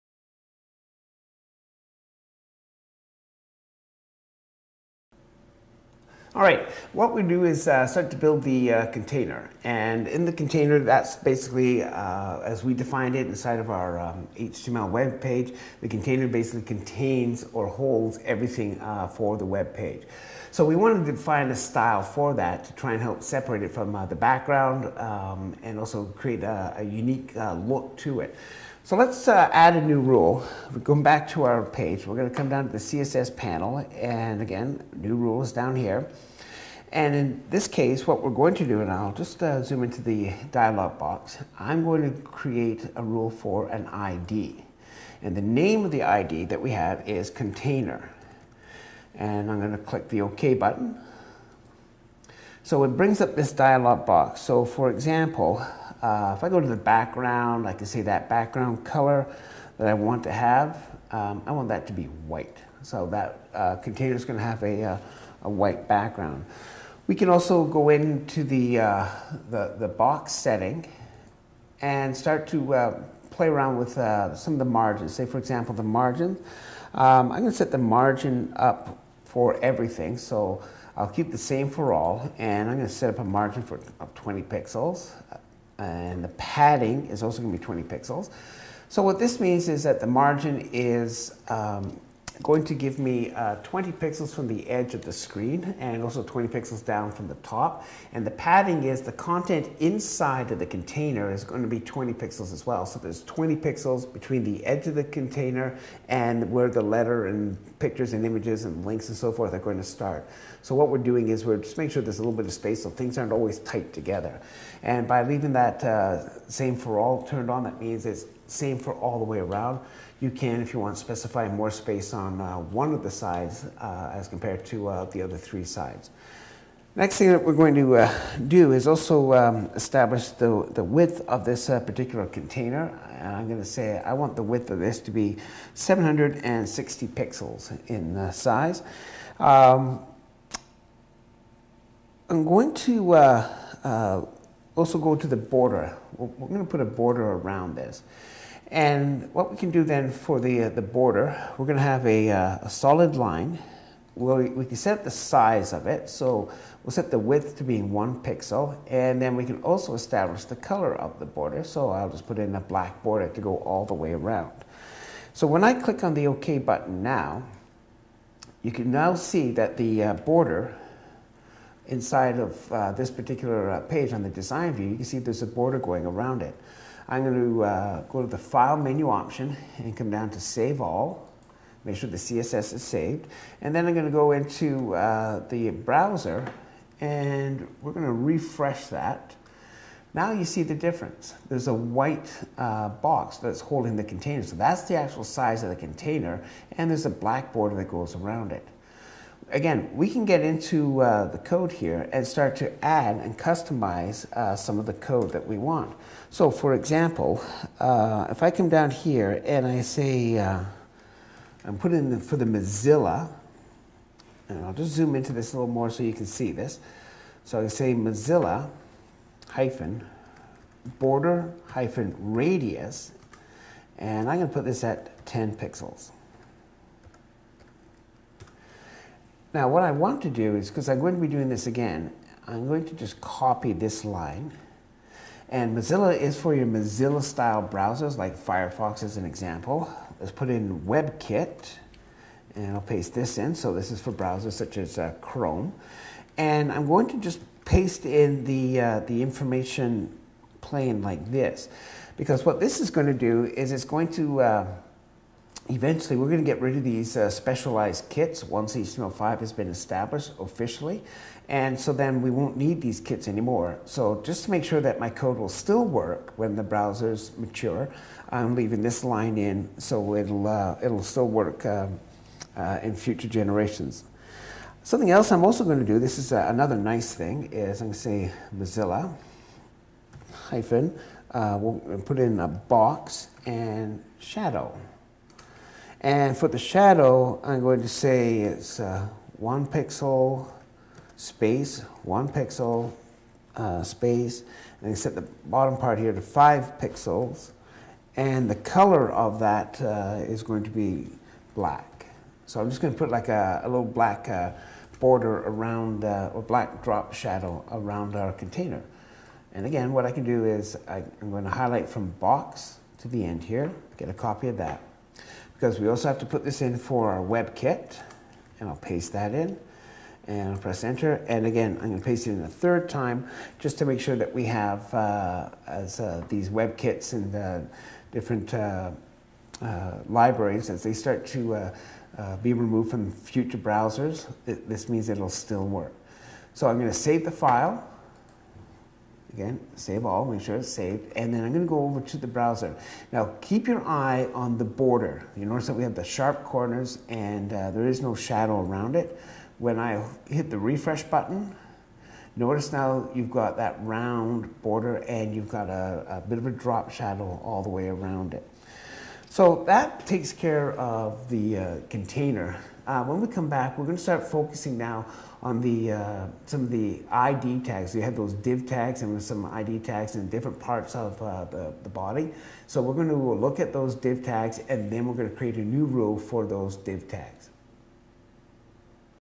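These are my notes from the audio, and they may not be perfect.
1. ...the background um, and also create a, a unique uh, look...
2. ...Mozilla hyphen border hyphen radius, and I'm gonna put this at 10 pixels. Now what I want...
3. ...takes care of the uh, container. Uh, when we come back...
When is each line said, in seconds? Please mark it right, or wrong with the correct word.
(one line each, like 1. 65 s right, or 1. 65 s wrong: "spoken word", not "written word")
1. 24 s right
2. 217 s right
3. 360 s right.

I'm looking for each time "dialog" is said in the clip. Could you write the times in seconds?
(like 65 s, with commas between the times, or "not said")
40 s, 53 s.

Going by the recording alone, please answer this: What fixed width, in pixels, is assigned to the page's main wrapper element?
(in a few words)
760 pixels.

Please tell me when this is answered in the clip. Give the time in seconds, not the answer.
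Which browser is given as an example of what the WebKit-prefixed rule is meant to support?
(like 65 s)
245 s.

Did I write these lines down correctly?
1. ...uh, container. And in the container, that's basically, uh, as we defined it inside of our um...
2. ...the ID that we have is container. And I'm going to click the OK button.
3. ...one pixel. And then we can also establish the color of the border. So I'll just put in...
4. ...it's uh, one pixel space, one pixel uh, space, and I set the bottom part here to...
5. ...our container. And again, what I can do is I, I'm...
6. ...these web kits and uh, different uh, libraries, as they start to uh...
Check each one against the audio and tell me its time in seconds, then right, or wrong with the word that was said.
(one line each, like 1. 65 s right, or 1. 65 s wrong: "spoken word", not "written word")
1. 8 s right
2. 45 s right
3. 157 s right
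4. 288 s right
5. 308 s right
6. 326 s right.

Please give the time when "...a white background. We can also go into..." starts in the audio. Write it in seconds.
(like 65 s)
65 s.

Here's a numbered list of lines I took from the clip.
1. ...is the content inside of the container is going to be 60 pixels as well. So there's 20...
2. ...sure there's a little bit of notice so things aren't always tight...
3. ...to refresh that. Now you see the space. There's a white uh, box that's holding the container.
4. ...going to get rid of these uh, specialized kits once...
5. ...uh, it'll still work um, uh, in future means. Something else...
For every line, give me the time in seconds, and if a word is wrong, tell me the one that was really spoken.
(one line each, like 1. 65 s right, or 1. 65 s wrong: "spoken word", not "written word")
1. 98 s wrong: "20", not "60"
2. 111 s wrong: "space", not "notice"
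3. 188 s wrong: "difference", not "space"
4. 256 s right
5. 270 s wrong: "generations", not "means".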